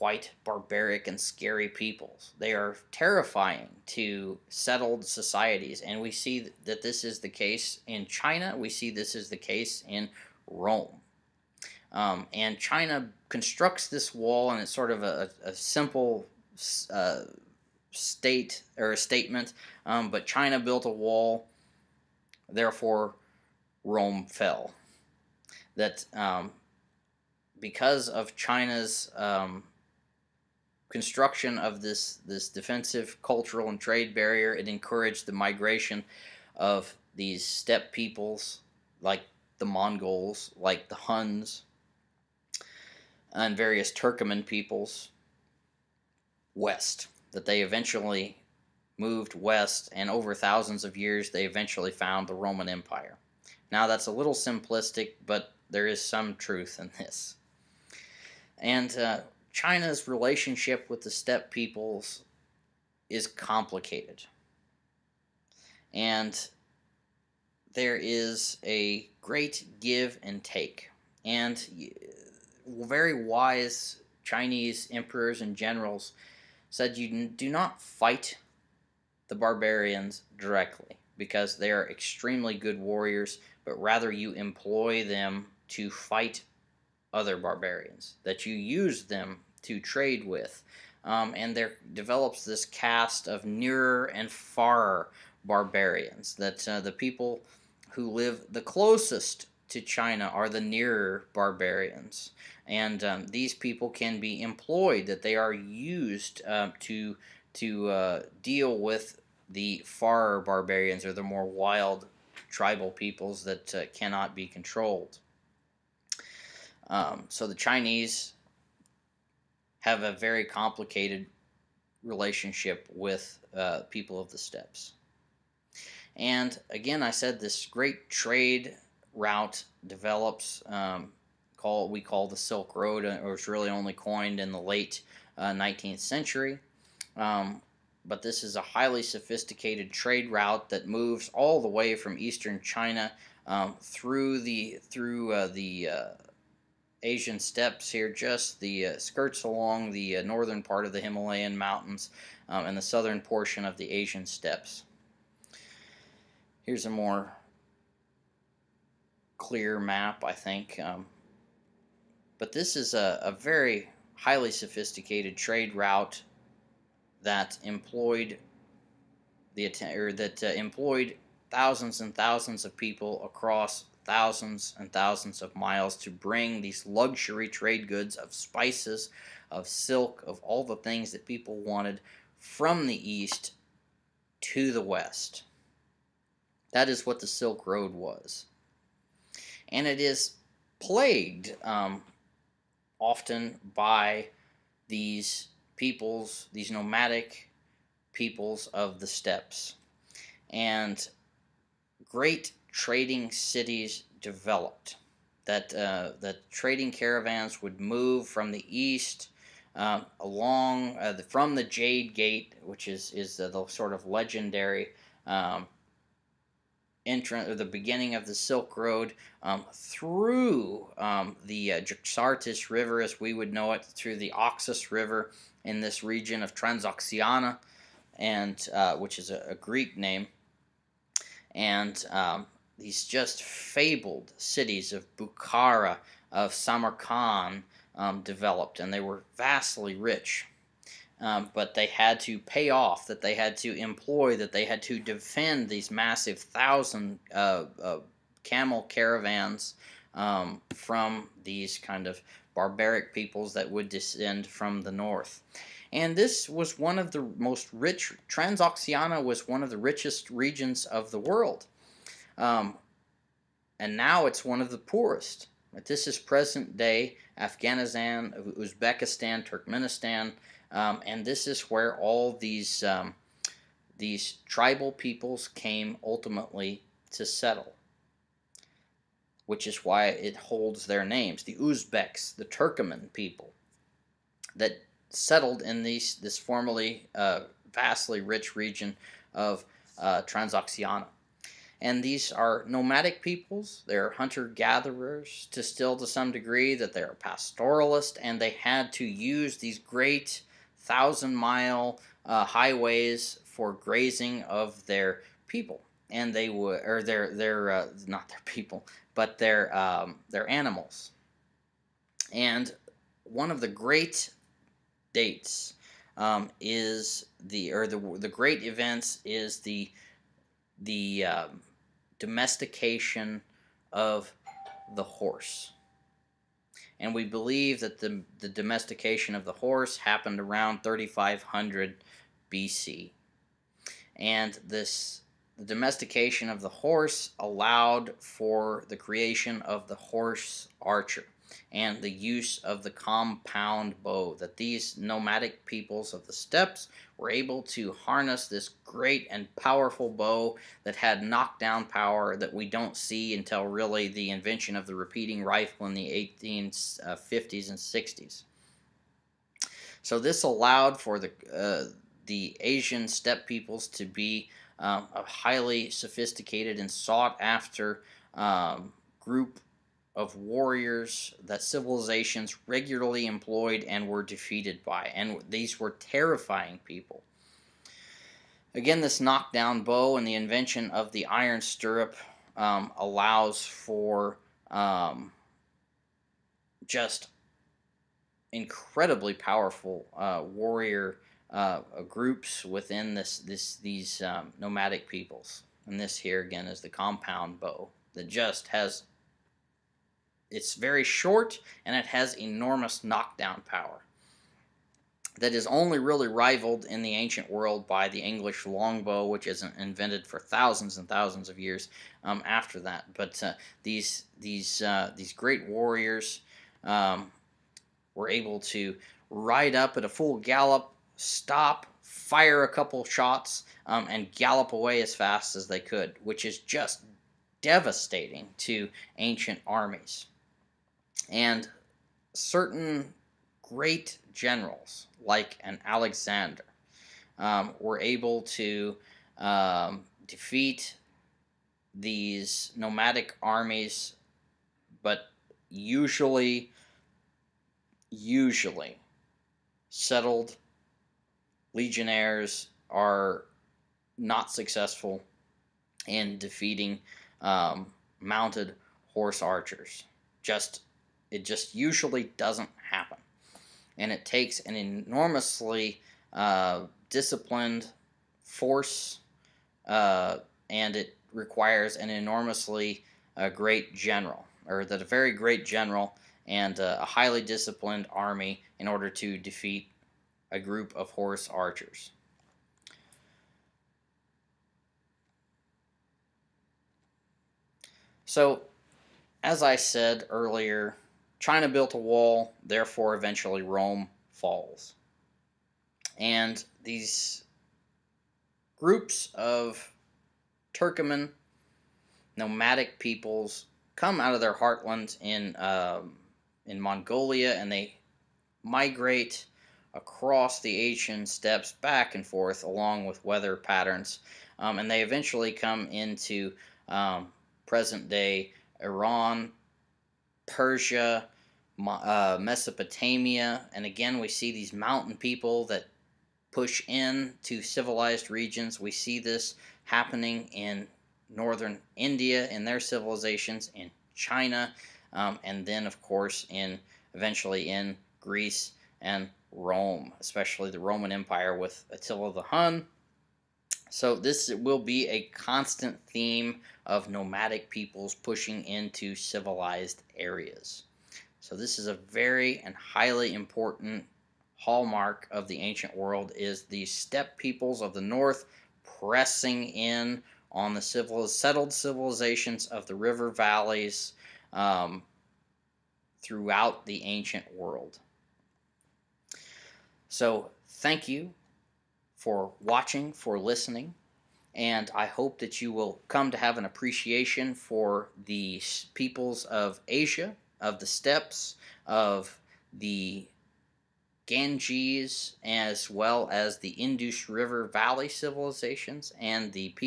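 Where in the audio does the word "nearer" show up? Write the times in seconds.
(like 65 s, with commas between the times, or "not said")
93 s, 100 s.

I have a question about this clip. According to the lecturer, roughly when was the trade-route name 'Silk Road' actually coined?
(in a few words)
late 19th century.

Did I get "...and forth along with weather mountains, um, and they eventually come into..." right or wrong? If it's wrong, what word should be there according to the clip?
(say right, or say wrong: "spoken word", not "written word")
wrong: "patterns", not "mountains".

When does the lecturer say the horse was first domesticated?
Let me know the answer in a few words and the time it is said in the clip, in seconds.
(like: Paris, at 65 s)
3500 BC, at 330 s.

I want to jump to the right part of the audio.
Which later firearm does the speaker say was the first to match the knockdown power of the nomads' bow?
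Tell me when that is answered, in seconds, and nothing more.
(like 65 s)
354 s.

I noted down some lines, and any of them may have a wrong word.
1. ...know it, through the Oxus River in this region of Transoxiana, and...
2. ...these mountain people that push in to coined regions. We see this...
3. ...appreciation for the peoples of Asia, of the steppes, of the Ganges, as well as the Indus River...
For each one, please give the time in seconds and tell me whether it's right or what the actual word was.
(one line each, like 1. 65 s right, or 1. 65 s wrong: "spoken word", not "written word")
1. 223 s right
2. 524 s wrong: "civilized", not "coined"
3. 576 s right.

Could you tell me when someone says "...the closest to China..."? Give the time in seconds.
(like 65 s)
98 s.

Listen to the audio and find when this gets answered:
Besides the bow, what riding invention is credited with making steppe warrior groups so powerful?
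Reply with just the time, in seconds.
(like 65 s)
381 s.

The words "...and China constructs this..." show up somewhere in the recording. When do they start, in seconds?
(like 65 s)
12 s.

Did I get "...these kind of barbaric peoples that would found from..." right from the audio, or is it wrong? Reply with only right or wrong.
wrong.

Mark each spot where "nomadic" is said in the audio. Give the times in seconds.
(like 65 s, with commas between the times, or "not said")
196 s, 292 s, 344 s, 394 s, 442 s, 502 s, 547 s.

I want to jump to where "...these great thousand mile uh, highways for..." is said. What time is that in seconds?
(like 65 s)
299 s.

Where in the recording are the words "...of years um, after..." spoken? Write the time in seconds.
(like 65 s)
411 s.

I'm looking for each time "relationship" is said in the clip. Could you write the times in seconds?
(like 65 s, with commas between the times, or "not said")
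60 s, 122 s.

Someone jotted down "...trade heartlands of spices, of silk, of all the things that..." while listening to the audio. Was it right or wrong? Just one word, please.
wrong.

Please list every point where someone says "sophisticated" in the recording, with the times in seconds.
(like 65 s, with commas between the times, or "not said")
139 s, 164 s, 365 s.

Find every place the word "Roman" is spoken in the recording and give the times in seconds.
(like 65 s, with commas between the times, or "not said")
52 s, 540 s.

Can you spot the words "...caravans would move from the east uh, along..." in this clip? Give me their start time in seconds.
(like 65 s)
206 s.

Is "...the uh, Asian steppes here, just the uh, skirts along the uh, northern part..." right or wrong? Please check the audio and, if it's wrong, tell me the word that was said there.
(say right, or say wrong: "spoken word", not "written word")
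right.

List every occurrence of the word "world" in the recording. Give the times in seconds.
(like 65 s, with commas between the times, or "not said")
261 s, 407 s, 555 s, 567 s.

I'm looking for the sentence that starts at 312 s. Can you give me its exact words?
And one of the great dates um, is the, or the, the great events is the, the, um, domestication of the horse.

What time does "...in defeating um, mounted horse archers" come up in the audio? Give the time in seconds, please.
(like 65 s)
456 s.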